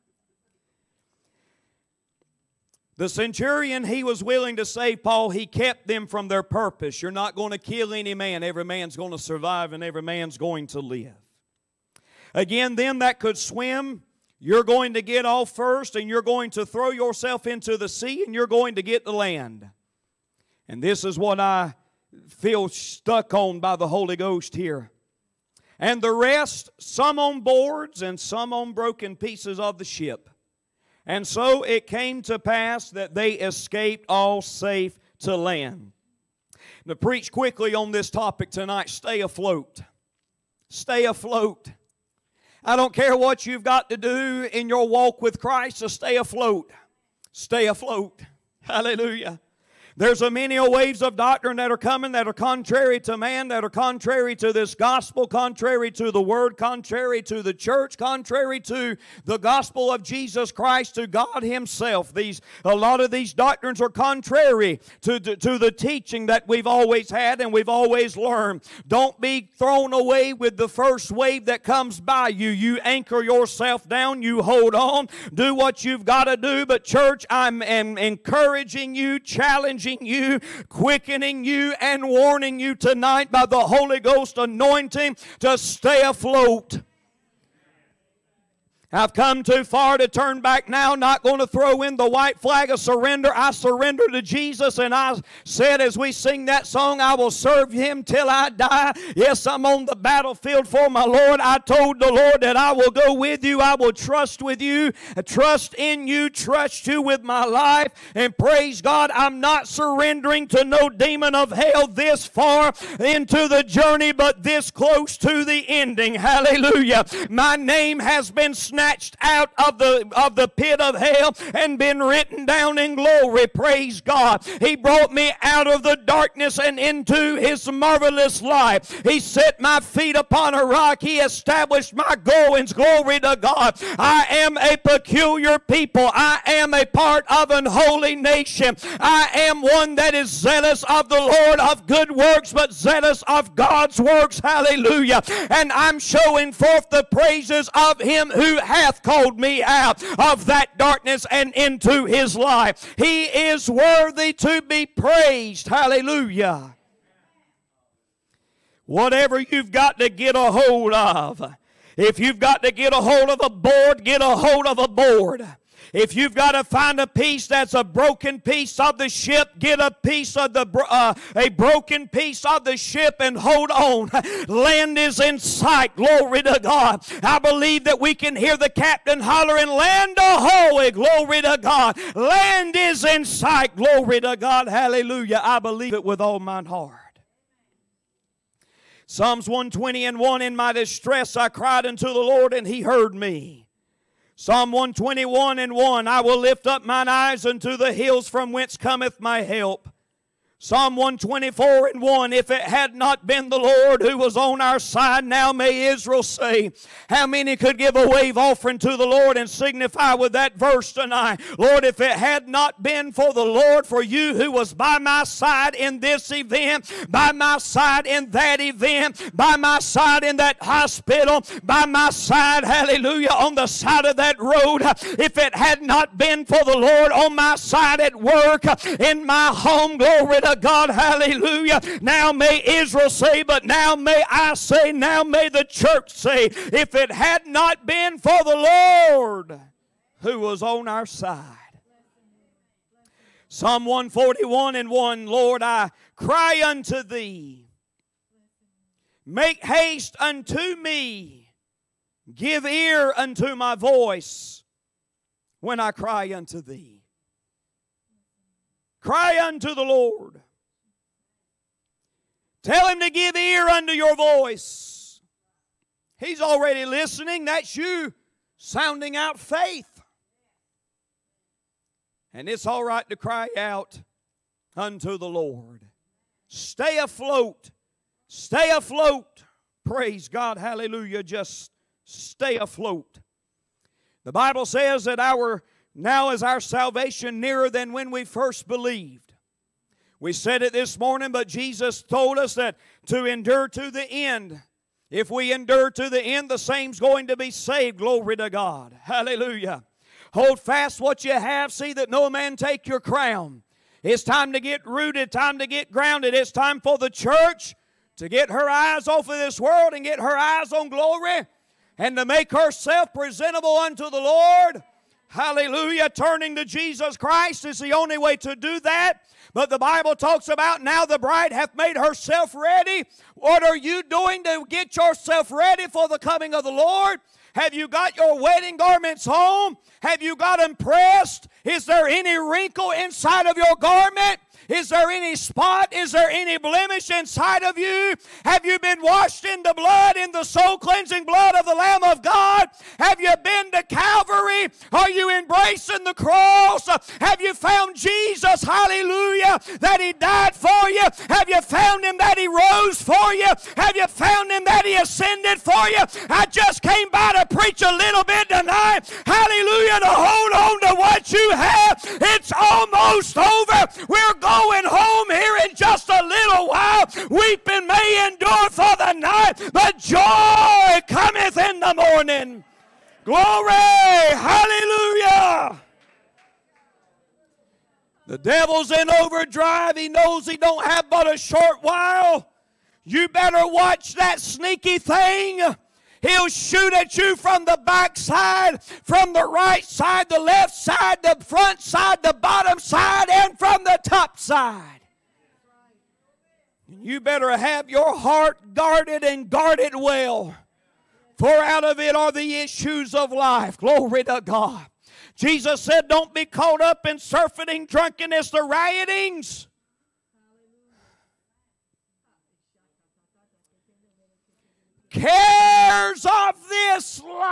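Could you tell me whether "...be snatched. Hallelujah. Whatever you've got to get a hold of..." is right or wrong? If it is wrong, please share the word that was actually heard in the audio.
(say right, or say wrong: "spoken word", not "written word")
wrong: "praised", not "snatched".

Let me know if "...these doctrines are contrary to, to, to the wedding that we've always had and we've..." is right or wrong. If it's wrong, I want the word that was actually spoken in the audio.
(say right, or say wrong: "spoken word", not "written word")
wrong: "teaching", not "wedding".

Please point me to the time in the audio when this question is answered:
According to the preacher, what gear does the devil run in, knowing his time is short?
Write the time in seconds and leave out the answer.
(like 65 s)
379 s.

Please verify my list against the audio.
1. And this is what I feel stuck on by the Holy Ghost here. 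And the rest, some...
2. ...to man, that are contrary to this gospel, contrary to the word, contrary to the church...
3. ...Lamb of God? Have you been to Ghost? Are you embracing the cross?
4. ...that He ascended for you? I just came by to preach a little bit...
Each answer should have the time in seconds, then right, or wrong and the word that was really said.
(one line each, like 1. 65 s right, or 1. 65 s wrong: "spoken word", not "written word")
1. 20 s right
2. 53 s right
3. 341 s wrong: "Calvary", not "Ghost"
4. 354 s right.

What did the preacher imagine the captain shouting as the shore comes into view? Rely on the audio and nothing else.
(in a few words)
Land ahoy.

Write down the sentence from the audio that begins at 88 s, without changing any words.
I've come too far to turn back now, not going to throw in the white flag of surrender.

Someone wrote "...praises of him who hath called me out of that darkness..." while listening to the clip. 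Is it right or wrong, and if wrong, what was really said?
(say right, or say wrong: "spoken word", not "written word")
right.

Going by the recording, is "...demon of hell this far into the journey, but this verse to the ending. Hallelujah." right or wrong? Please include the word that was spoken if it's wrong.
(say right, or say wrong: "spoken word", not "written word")
wrong: "close", not "verse".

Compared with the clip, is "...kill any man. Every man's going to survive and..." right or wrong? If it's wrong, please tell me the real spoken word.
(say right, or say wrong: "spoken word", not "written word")
right.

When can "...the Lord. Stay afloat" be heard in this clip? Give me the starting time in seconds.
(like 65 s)
275 s.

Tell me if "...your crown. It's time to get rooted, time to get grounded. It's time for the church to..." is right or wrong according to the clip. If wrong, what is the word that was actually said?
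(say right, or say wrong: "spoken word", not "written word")
right.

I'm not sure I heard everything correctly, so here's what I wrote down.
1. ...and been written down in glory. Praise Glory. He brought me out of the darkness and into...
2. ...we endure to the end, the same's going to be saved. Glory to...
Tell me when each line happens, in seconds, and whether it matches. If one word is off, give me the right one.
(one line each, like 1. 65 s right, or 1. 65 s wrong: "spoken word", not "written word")
1. 121 s wrong: "God", not "Glory"
2. 295 s right.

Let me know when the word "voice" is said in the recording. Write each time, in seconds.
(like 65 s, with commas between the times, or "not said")
253 s, 264 s.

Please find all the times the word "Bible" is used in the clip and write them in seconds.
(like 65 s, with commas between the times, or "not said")
284 s, 319 s.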